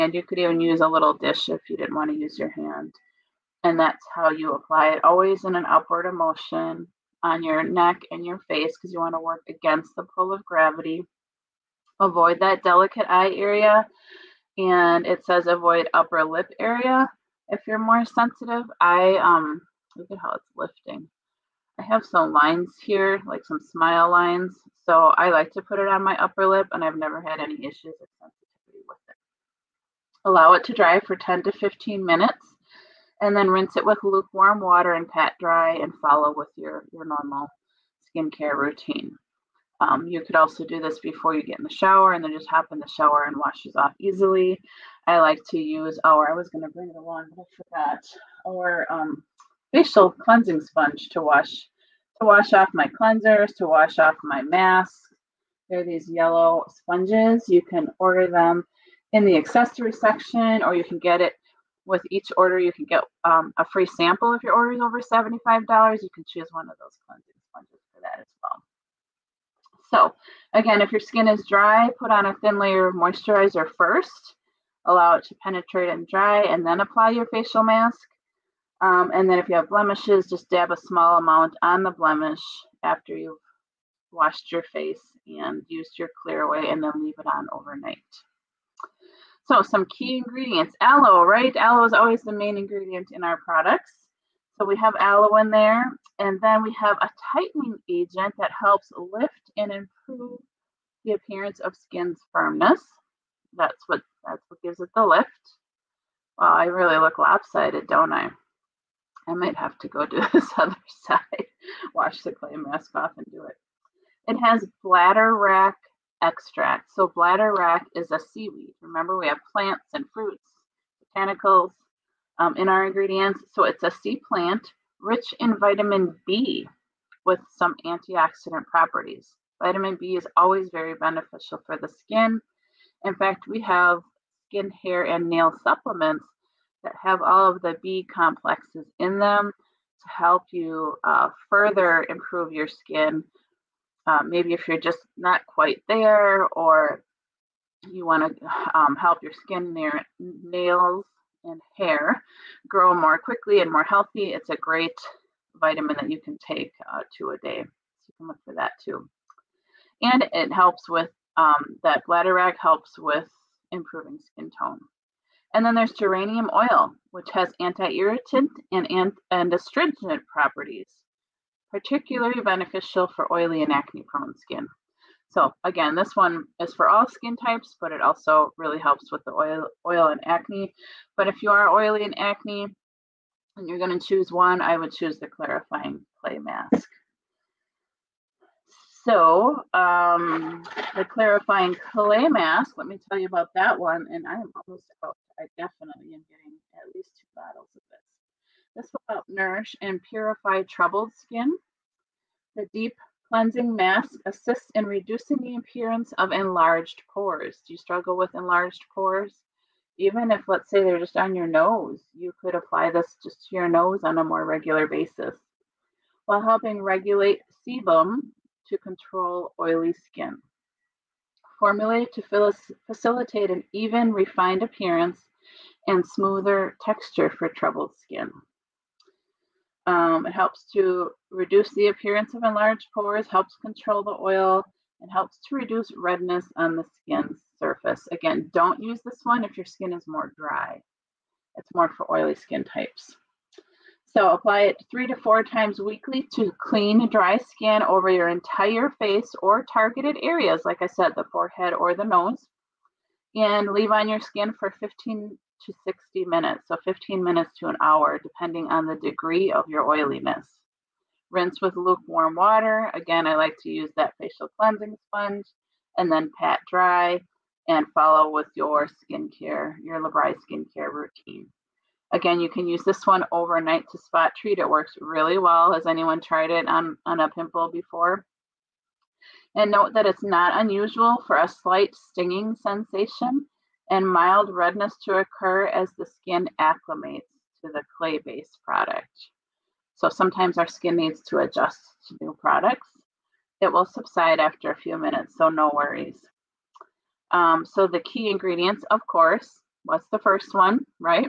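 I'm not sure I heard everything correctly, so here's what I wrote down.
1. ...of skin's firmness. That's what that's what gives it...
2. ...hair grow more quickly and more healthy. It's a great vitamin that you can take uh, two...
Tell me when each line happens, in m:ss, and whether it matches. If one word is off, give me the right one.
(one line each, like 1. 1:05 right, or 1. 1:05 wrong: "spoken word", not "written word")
1. 1:41 right
2. 2:31 right.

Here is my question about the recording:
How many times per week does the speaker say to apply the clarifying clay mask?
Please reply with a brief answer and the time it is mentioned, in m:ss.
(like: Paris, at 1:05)
3 to 4 times, at 4:04.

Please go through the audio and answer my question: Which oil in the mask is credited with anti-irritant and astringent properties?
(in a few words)
Geranium oil.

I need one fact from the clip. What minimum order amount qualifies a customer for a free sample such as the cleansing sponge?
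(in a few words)
$75.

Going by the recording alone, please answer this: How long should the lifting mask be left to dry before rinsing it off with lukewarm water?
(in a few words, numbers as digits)
10 to 15 minutes.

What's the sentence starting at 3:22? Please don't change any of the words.
The deep Cleansing mask assists in reducing the appearance of enlarged pores.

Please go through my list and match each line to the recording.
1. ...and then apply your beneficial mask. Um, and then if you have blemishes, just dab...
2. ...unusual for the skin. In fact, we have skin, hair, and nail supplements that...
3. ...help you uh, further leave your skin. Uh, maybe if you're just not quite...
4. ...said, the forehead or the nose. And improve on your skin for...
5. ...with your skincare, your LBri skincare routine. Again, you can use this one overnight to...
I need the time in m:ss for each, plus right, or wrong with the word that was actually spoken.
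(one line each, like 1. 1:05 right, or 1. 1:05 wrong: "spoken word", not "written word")
1. 1:16 wrong: "facial", not "beneficial"
2. 2:10 wrong: "beneficial", not "unusual"
3. 2:20 wrong: "improve", not "leave"
4. 4:10 wrong: "leave", not "improve"
5. 4:28 right.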